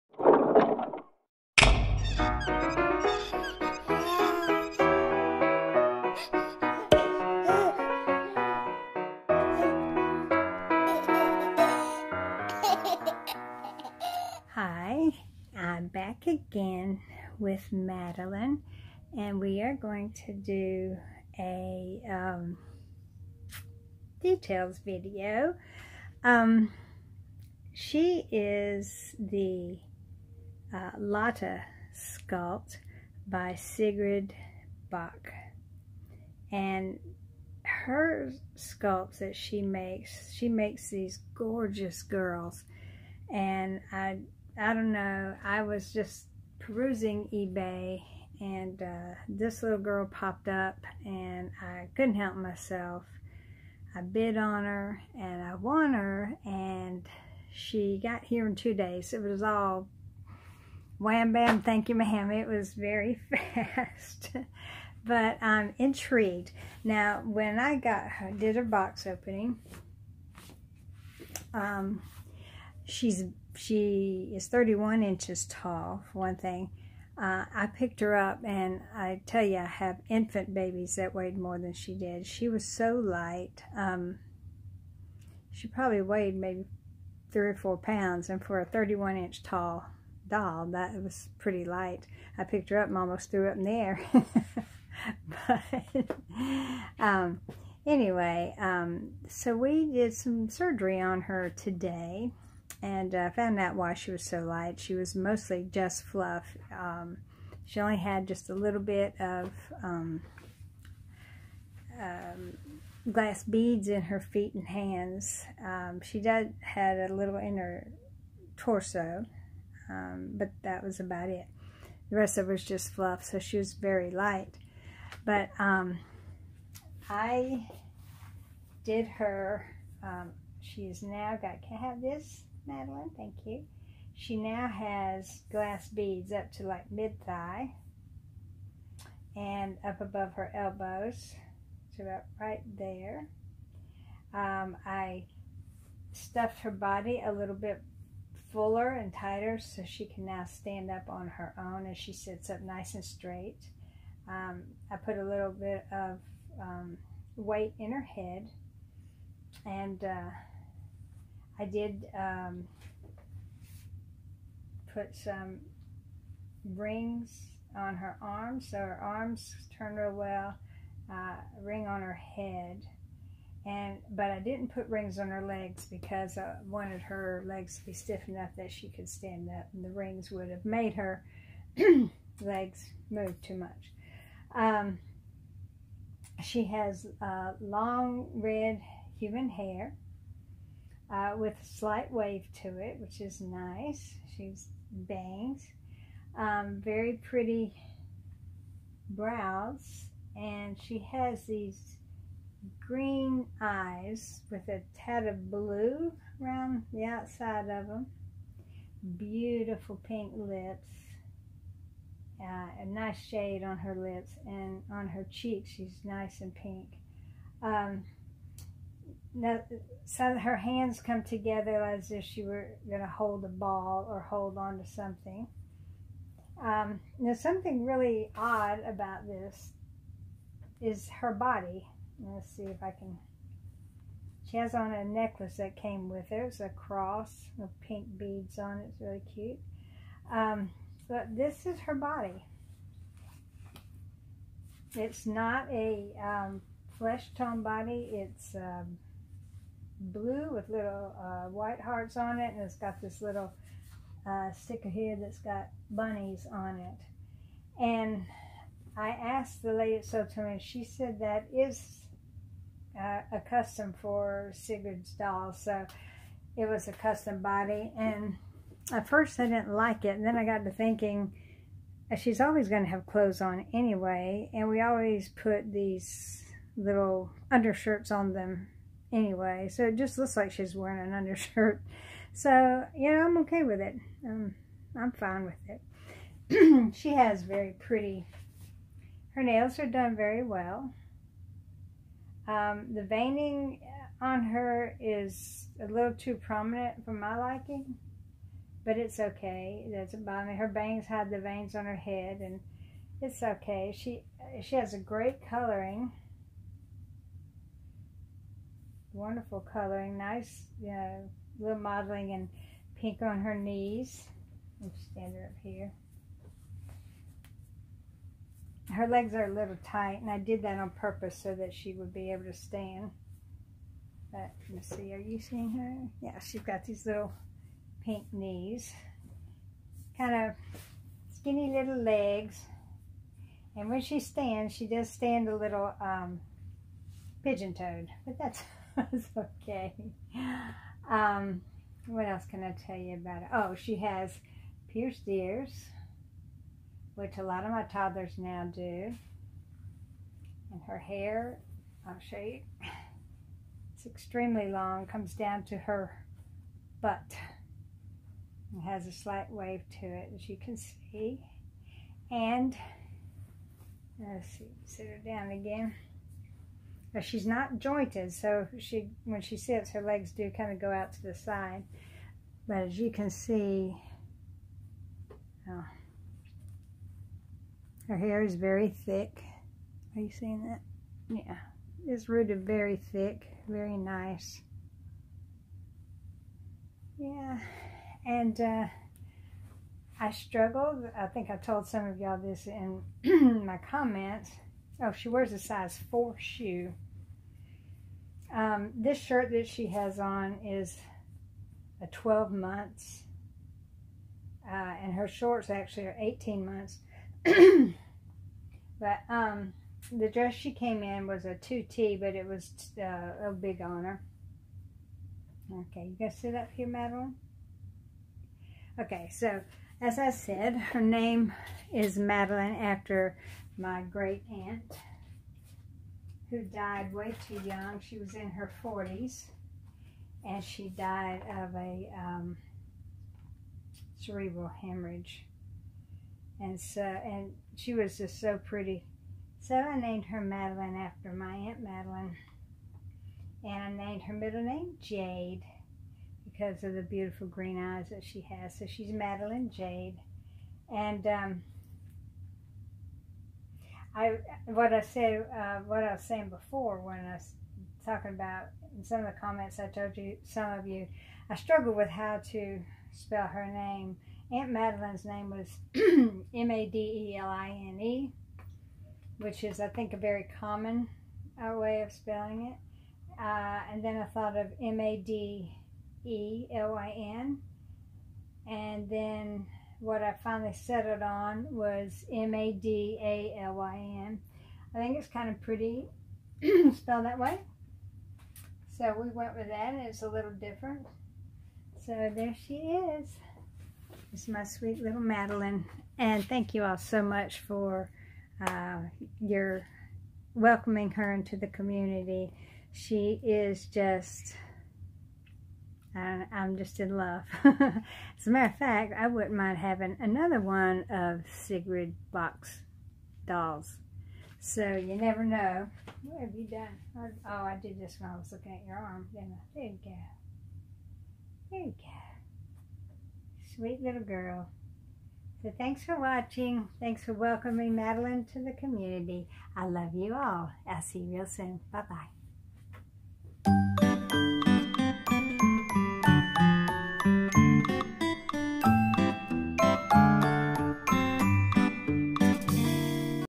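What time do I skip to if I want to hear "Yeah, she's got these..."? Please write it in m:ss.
5:26.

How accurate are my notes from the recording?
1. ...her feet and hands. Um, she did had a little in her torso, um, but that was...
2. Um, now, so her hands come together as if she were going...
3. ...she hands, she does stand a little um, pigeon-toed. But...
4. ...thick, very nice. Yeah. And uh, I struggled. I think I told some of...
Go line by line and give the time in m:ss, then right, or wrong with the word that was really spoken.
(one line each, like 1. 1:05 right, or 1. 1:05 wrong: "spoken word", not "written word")
1. 1:54 right
2. 3:37 right
3. 5:34 wrong: "stands", not "hands"
4. 6:23 right.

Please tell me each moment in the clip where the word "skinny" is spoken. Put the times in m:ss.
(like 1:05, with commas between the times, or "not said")
5:31.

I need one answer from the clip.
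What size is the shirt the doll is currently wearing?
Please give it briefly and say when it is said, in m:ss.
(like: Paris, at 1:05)
12 months, at 6:42.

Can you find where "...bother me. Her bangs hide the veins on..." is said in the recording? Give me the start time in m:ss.
5:00.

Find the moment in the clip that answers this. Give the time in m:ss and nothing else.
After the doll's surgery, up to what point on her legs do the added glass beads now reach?
2:16.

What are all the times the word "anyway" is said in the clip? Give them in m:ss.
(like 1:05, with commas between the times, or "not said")
1:37, 4:33, 4:39.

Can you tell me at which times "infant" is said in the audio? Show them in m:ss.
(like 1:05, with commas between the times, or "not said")
1:20.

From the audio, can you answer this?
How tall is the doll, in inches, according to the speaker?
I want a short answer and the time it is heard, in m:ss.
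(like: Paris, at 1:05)
31 inches, at 1:14.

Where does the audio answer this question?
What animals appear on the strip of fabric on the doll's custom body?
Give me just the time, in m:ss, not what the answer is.
4:15.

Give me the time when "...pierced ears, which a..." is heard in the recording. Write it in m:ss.
5:44.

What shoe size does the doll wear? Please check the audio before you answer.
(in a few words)
4.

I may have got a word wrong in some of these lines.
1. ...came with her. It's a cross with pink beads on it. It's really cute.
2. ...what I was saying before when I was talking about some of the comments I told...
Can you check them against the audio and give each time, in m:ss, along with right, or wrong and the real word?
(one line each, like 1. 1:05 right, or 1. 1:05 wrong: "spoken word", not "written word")
1. 3:55 right
2. 7:35 right.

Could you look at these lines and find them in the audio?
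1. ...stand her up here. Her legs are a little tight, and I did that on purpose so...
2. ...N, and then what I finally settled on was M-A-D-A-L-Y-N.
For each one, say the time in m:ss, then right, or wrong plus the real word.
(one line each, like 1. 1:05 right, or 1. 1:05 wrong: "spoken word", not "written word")
1. 5:15 right
2. 7:57 right.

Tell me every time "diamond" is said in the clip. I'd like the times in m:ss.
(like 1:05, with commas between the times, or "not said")
not said.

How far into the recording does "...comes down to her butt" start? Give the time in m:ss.
5:55.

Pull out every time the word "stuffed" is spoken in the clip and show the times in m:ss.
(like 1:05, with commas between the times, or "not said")
2:26.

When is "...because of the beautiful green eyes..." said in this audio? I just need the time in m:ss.
7:26.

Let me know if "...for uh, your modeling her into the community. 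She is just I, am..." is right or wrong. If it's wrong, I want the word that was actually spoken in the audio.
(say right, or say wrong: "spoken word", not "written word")
wrong: "welcoming", not "modeling".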